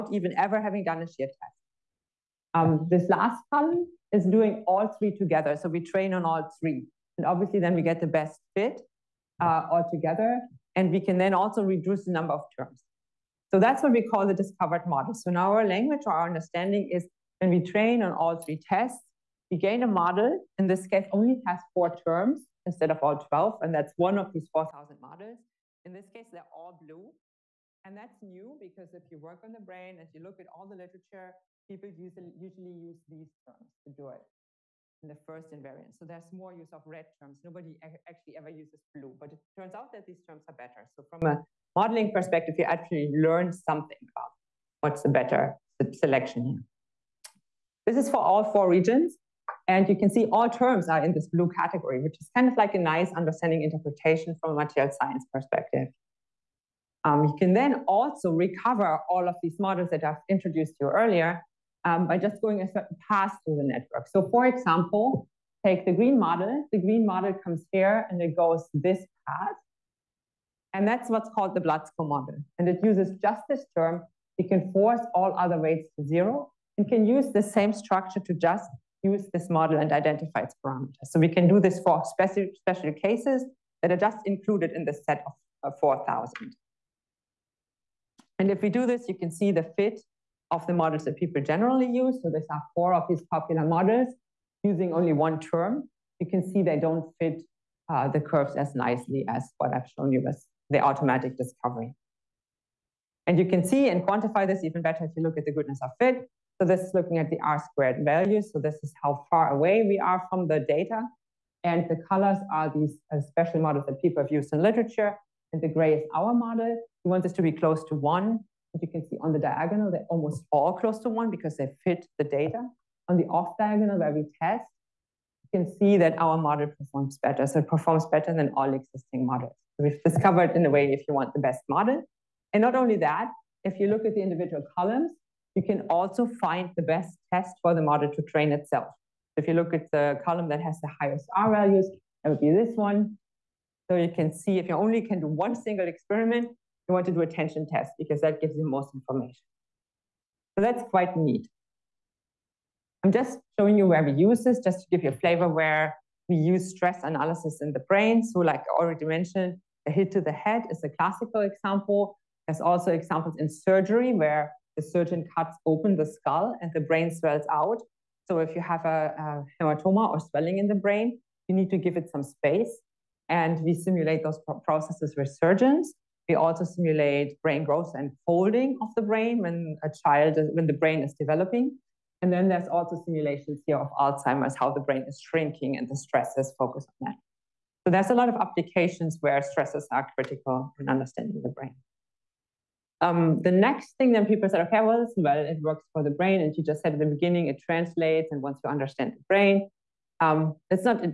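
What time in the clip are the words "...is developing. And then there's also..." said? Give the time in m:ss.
3:01.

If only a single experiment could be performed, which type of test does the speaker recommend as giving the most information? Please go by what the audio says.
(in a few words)
Tension test.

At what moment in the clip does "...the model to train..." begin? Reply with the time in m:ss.
2:17.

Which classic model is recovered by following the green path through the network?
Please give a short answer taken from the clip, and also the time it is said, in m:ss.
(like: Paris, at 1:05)
Blatz-Ko model, at 1:11.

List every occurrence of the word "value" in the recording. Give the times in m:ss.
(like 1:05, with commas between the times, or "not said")
1:48, 2:21.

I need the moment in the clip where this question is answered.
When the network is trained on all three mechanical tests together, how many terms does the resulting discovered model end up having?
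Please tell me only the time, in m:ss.
0:21.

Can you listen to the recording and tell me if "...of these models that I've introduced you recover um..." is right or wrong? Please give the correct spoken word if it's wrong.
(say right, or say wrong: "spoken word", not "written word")
wrong: "earlier", not "recover".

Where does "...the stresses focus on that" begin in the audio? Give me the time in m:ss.
3:05.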